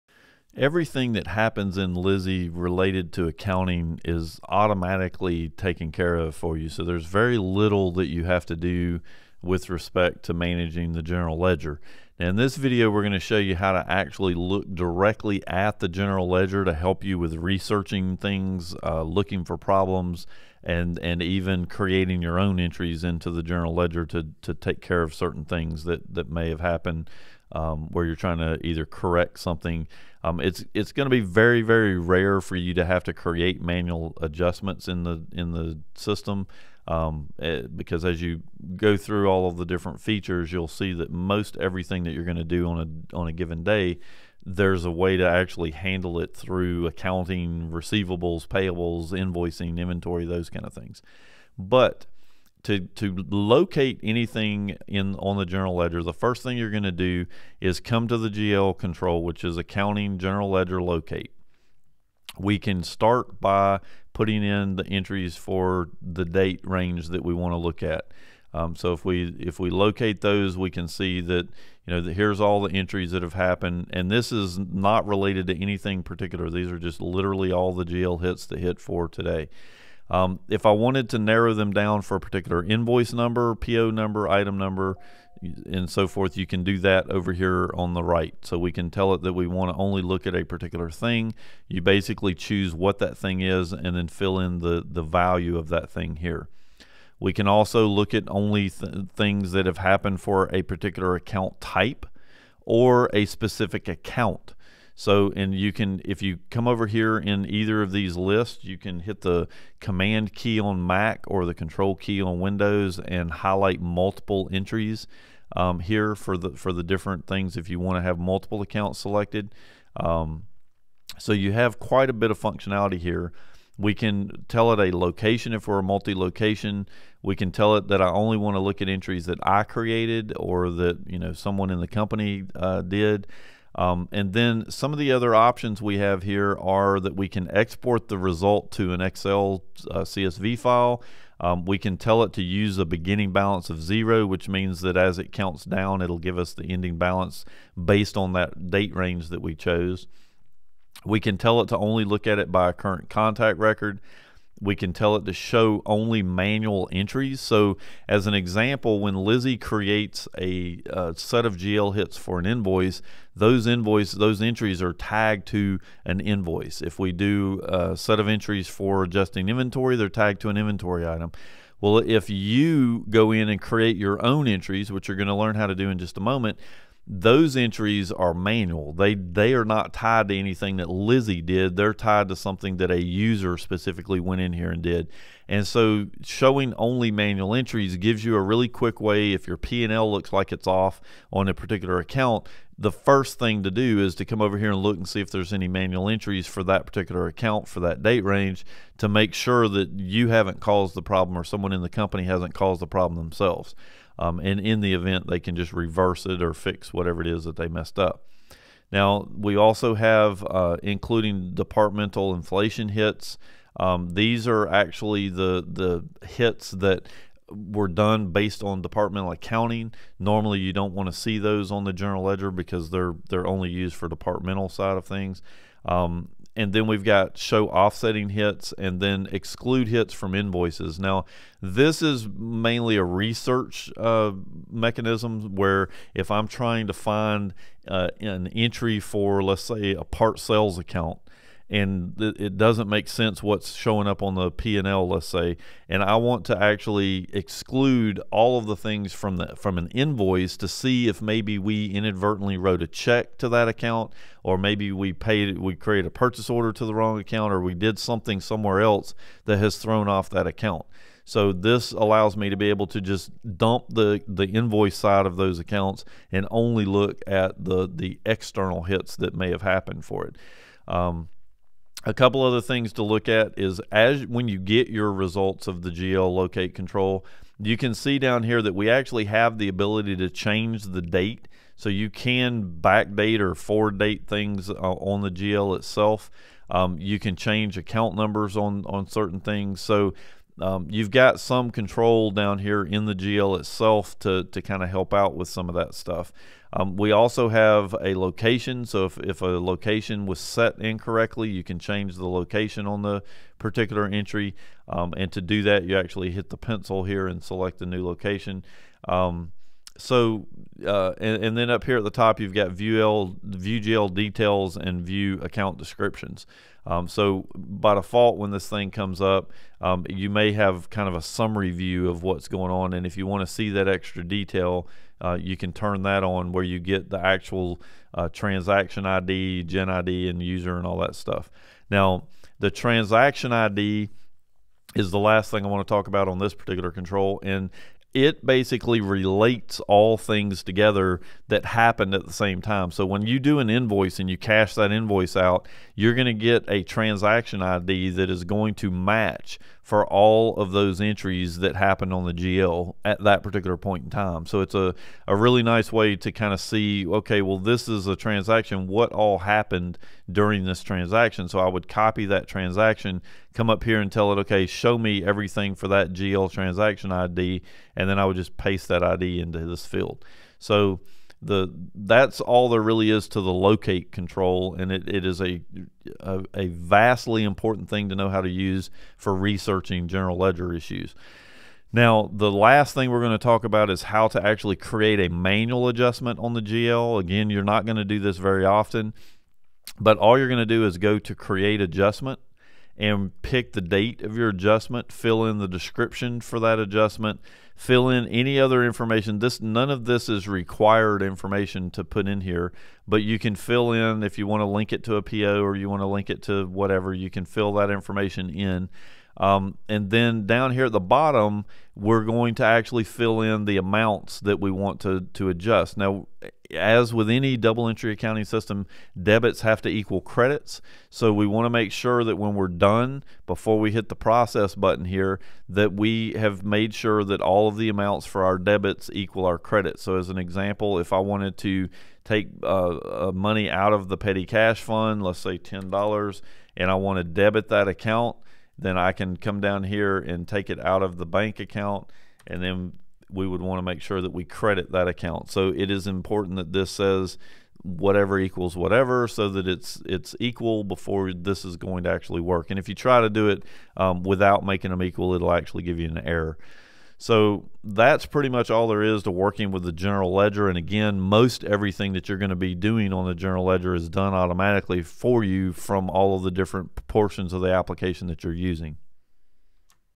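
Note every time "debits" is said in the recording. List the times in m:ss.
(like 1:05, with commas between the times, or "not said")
6:59, 7:08, 7:17.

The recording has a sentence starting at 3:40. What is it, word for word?
Normally, you don't want to see those on the general ledger because they're they're only used for departmental side of things.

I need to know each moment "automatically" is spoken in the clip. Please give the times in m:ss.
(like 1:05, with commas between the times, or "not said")
0:04, 7:44.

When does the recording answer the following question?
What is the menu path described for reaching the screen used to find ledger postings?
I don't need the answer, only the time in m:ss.
0:59.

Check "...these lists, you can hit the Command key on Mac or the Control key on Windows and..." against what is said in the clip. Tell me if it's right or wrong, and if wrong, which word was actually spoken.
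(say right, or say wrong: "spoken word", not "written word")
right.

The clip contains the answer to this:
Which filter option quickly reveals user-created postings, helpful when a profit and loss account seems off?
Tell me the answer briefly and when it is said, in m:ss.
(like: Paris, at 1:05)
Show only manual entries, at 2:35.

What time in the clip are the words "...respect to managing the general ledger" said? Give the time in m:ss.
0:09.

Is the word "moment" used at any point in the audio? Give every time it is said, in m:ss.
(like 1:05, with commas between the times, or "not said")
2:56.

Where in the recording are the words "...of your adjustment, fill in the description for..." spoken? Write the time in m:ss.
6:34.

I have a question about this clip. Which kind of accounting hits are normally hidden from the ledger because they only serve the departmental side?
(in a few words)
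Departmental inflation hits.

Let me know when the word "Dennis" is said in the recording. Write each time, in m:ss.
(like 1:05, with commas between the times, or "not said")
not said.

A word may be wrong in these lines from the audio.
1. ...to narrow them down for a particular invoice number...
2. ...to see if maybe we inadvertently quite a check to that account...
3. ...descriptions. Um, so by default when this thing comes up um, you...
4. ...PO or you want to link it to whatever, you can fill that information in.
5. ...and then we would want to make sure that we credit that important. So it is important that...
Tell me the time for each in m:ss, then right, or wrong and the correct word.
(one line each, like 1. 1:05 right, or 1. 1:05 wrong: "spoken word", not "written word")
1. 1:21 right
2. 4:10 wrong: "wrote", not "quite"
3. 5:15 right
4. 6:45 right
5. 7:22 wrong: "account", not "important".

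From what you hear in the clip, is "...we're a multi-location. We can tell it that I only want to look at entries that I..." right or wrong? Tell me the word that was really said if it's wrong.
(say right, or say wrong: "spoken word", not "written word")
right.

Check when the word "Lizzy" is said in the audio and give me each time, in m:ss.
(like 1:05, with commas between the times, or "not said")
0:01, 2:39, 3:00.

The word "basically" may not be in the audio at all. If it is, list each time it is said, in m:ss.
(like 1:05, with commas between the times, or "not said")
1:31, 5:38.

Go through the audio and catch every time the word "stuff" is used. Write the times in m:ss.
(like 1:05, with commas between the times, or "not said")
4:55, 5:31.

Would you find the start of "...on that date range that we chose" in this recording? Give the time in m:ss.
2:28.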